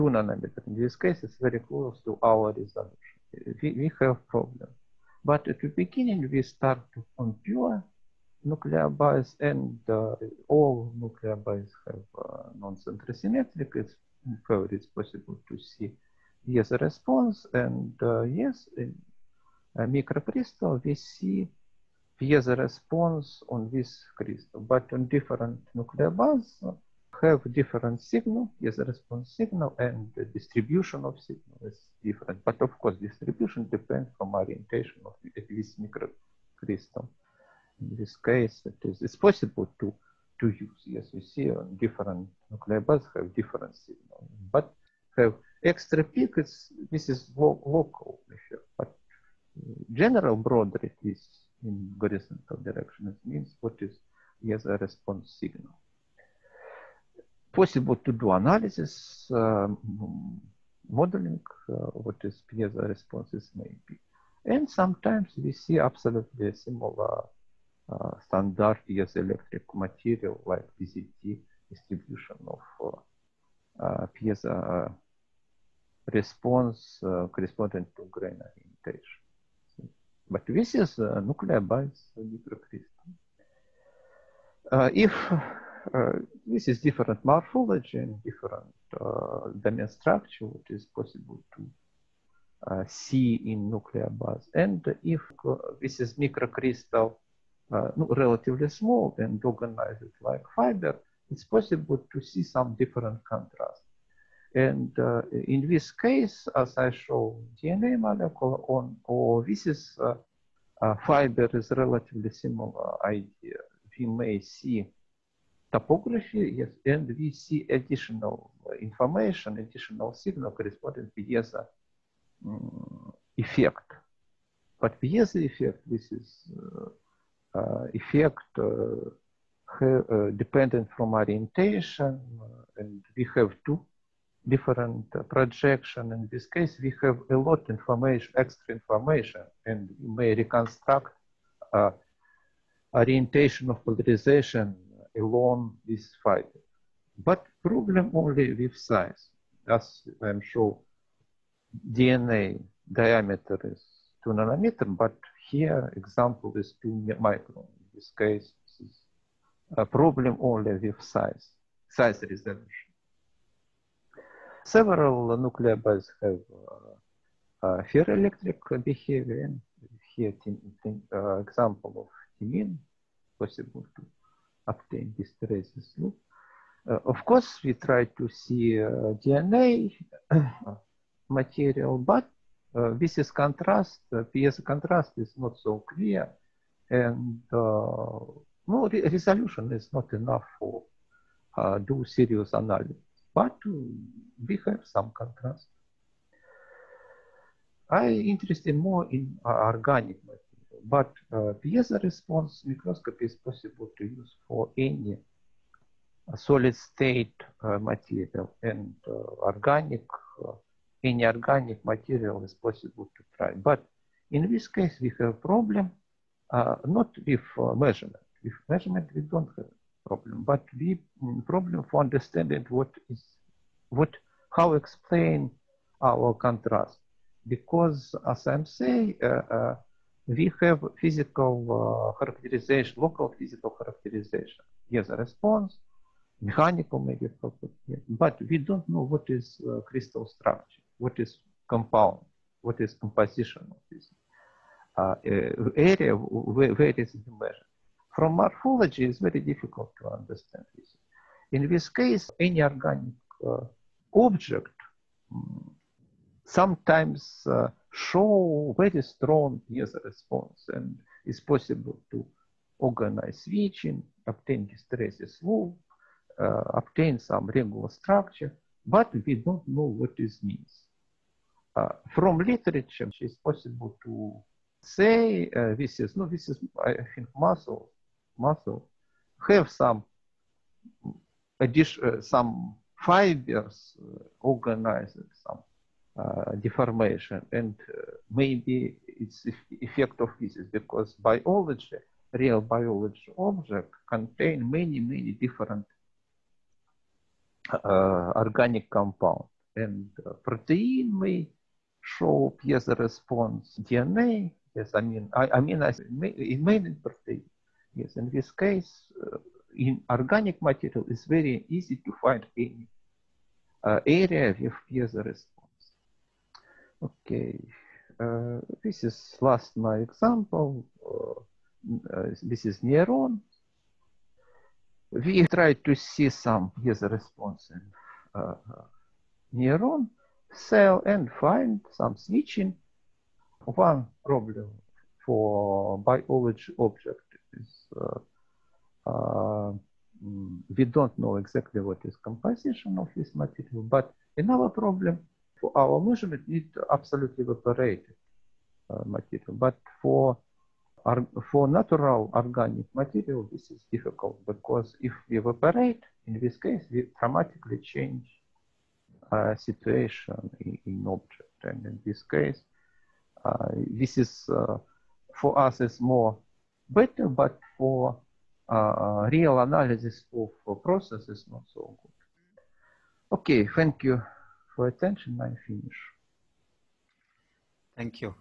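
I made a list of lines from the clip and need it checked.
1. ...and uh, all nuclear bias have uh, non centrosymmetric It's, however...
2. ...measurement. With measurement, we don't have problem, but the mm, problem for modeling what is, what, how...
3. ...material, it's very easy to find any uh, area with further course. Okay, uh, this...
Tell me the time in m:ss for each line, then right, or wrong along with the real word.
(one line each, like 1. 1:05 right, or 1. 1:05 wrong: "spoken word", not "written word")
1. 0:09 right
2. 3:37 wrong: "understanding", not "modeling"
3. 5:10 wrong: "response", not "course".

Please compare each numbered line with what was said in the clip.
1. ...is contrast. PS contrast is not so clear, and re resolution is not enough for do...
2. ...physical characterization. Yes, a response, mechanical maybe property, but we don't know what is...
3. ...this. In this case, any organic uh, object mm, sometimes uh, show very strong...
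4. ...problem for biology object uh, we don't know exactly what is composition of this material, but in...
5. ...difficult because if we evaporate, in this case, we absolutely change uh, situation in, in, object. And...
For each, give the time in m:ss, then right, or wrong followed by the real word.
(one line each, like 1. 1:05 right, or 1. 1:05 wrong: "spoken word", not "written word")
1. 3:03 right
2. 3:53 right
3. 4:10 right
4. 5:34 right
5. 5:53 wrong: "dramatically", not "absolutely".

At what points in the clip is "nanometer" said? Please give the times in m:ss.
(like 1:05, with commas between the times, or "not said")
0:00, 2:34.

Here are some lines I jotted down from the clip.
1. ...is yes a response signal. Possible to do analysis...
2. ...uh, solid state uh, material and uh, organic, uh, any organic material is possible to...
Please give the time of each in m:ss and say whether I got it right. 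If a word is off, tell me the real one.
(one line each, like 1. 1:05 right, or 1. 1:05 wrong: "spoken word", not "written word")
1. 0:53 right
2. 3:26 right.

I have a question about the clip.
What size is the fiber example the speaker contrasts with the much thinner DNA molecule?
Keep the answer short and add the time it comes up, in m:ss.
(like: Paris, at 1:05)
2 microns, at 2:36.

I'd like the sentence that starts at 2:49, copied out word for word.
And here, uh, example of DNA possible to obtain this traces loop.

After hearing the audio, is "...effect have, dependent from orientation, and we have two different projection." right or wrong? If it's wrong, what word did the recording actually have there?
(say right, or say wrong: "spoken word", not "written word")
right.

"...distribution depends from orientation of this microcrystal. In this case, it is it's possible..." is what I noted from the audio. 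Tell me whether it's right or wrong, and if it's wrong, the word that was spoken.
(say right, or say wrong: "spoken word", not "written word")
right.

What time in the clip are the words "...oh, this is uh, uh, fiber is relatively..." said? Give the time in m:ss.
1:49.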